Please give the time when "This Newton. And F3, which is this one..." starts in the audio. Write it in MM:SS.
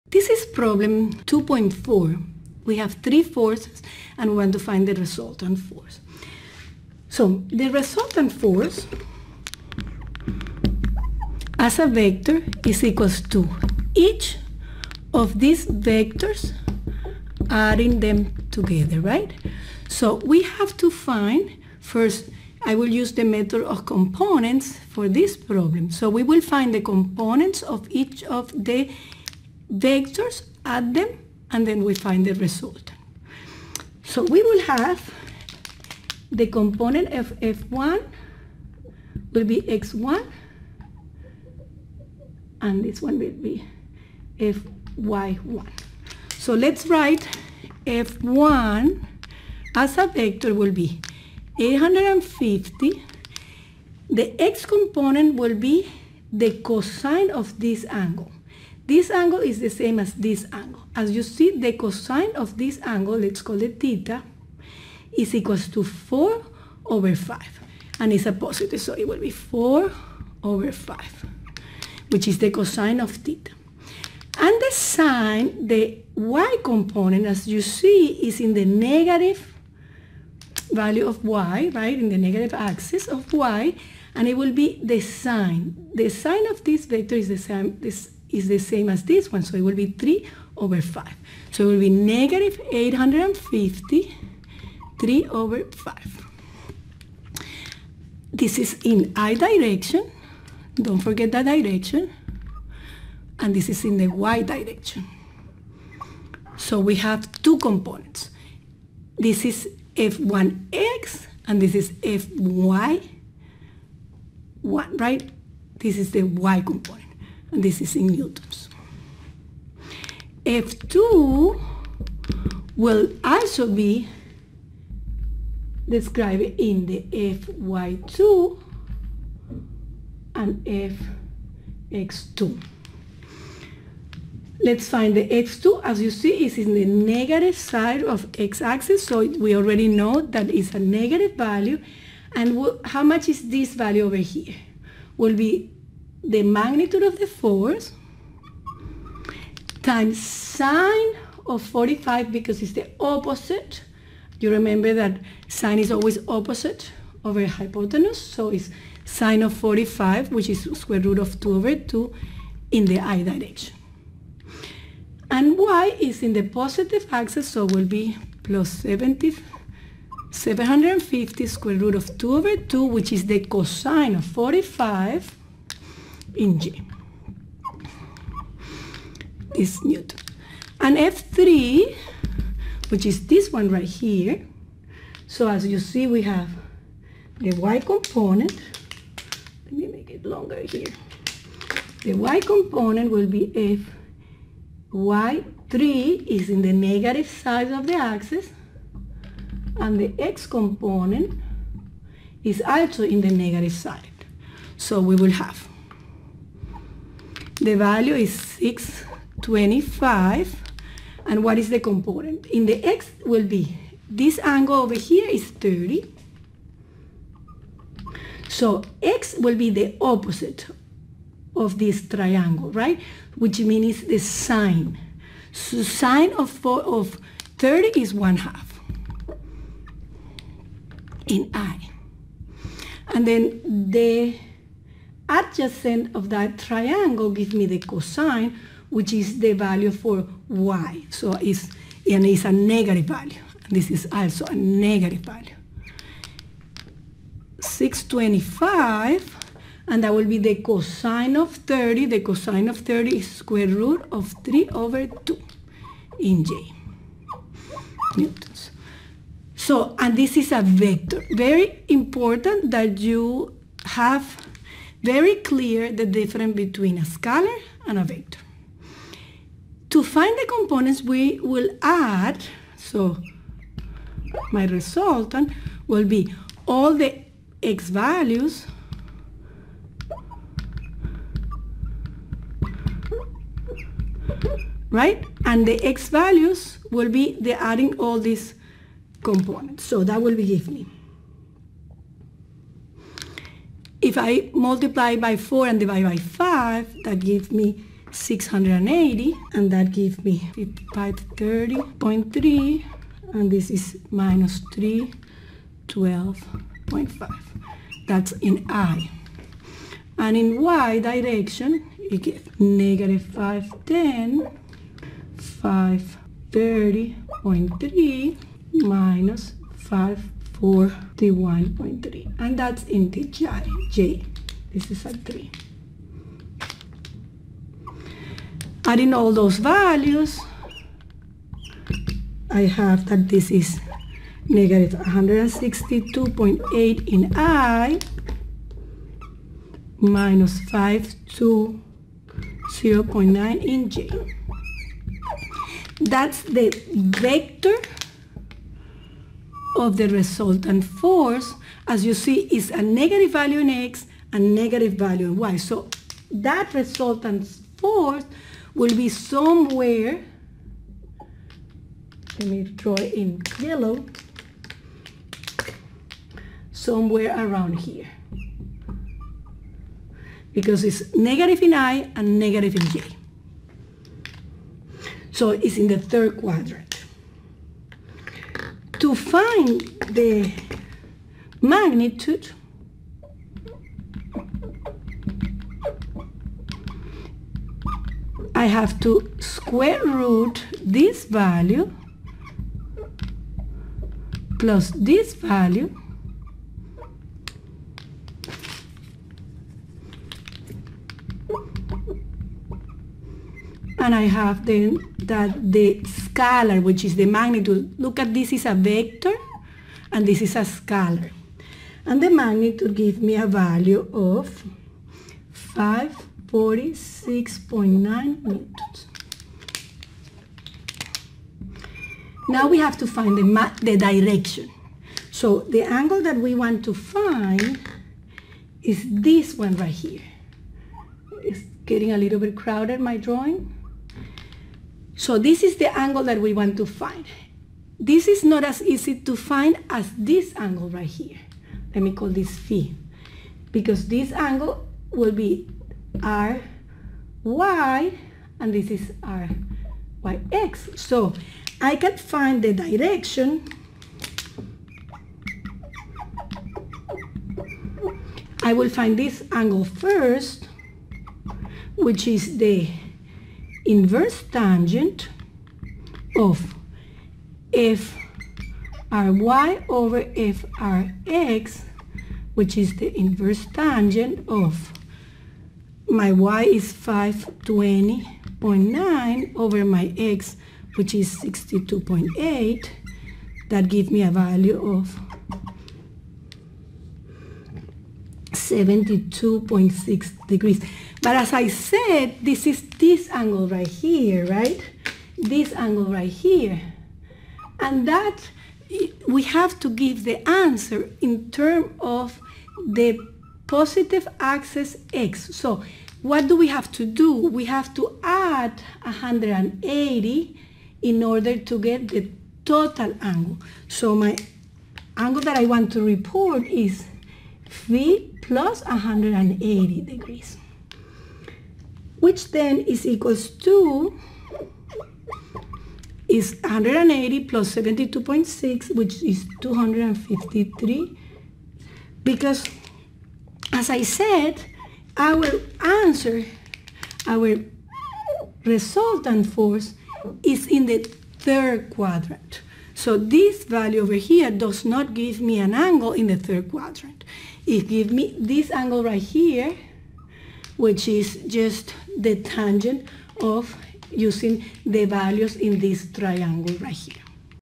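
02:59.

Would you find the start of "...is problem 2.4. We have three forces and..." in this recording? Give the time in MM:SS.
00:00.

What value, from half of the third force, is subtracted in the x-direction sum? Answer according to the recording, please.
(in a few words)
312.5.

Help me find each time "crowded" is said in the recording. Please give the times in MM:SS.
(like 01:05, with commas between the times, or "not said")
07:12.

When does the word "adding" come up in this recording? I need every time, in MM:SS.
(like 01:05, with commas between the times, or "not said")
00:17, 04:47, 05:28.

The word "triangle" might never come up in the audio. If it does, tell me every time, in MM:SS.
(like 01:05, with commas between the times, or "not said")
03:42, 03:56, 09:16.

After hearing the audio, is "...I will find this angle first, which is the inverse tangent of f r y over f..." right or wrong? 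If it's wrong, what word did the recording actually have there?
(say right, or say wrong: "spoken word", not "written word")
right.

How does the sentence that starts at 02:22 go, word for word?
And how much is this value over here?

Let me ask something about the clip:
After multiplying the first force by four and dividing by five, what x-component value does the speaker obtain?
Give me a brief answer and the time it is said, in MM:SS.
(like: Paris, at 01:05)
680, at 04:58.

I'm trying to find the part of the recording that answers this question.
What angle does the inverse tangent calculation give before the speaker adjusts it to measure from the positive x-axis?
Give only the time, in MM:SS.
08:08.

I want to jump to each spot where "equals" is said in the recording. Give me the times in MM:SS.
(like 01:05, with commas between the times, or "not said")
00:12, 01:05, 08:43.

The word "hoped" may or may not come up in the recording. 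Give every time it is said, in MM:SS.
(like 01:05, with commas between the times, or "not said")
not said.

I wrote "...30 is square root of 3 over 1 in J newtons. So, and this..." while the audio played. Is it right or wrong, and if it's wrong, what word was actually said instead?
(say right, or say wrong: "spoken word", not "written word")
wrong: "2", not "1".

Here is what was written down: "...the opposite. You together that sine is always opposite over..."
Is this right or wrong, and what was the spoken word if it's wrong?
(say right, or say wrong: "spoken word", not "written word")
wrong: "remember", not "together".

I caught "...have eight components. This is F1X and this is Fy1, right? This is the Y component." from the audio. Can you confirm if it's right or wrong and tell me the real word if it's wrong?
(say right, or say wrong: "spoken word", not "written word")
wrong: "two", not "eight".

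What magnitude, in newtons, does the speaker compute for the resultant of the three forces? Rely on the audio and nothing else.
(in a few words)
546.9.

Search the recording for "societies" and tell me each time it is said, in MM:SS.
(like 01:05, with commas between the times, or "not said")
not said.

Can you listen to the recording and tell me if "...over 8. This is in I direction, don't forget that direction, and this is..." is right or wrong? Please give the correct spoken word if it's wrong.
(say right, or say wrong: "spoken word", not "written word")
wrong: "5", not "8".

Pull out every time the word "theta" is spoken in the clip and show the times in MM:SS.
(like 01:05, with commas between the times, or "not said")
01:03, 01:13.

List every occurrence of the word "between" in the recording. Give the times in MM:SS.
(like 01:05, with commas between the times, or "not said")
04:26.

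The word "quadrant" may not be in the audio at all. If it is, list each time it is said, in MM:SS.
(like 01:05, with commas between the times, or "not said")
06:16, 09:01, 09:06.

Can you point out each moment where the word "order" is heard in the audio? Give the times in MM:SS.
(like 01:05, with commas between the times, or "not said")
08:31.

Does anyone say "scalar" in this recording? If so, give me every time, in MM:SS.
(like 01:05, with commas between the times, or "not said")
04:27, 06:46, 06:50.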